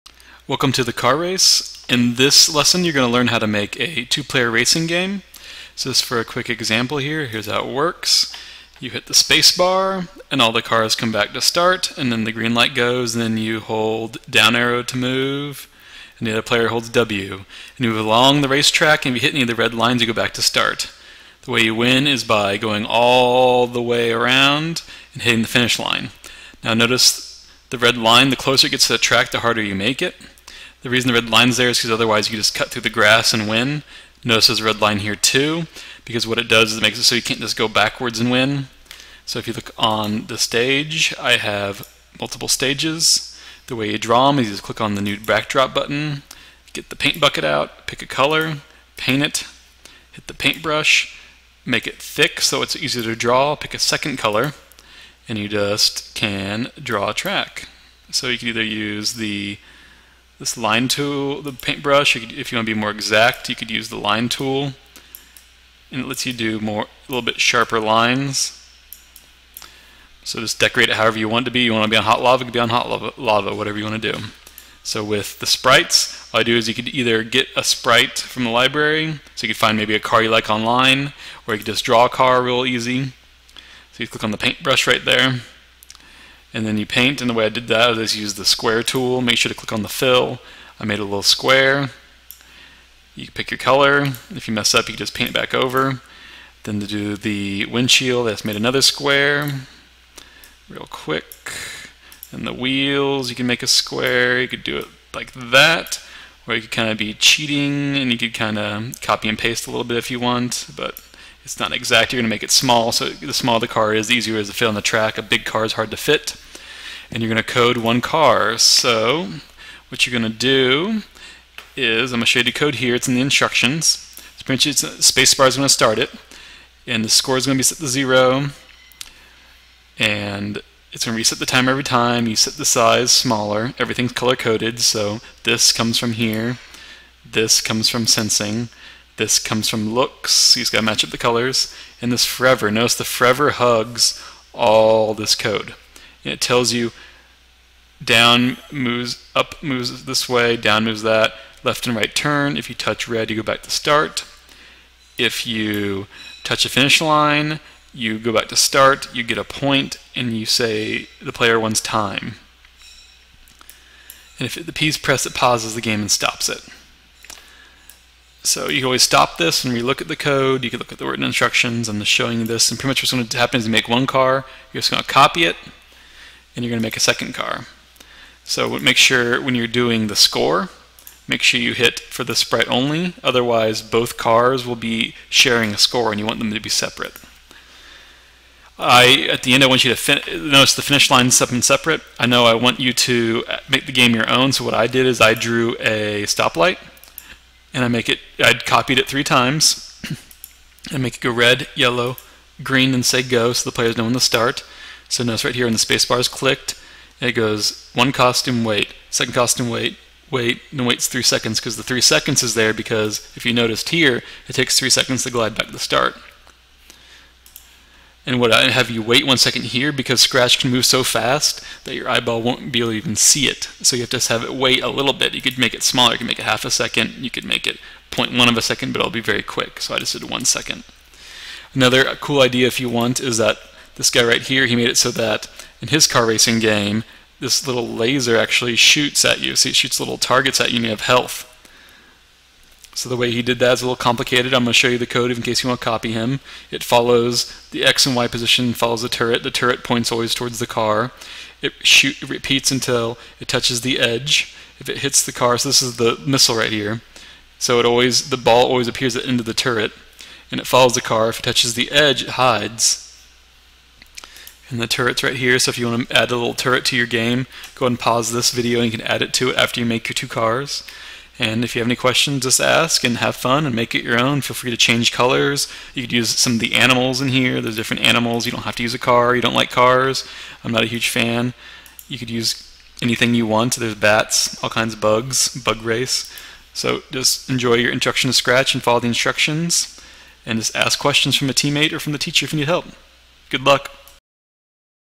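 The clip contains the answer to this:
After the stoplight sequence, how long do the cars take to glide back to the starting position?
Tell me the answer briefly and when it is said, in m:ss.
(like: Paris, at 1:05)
3 seconds, at 3:34.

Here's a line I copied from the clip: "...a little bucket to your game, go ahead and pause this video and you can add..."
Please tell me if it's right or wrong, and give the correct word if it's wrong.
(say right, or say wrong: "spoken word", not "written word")
wrong: "turret", not "bucket".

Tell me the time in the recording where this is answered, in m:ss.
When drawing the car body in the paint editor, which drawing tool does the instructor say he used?
1:28.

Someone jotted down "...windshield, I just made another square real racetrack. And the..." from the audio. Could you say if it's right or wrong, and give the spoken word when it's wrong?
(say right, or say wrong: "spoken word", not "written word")
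wrong: "quick", not "racetrack".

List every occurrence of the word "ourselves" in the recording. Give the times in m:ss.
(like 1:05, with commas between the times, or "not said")
not said.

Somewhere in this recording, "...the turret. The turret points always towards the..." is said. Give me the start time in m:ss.
4:09.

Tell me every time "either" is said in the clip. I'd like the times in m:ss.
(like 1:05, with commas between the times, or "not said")
0:58, 1:16.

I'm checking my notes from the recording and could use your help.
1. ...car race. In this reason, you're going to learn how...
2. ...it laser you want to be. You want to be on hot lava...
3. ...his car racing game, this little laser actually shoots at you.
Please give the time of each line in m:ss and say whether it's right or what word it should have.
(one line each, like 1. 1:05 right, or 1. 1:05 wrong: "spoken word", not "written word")
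1. 0:00 wrong: "lesson", not "reason"
2. 1:10 wrong: "however", not "laser"
3. 3:55 right.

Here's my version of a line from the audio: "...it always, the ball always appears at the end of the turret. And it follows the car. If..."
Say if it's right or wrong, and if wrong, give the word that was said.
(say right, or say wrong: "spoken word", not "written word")
right.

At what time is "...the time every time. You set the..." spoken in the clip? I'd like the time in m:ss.
2:11.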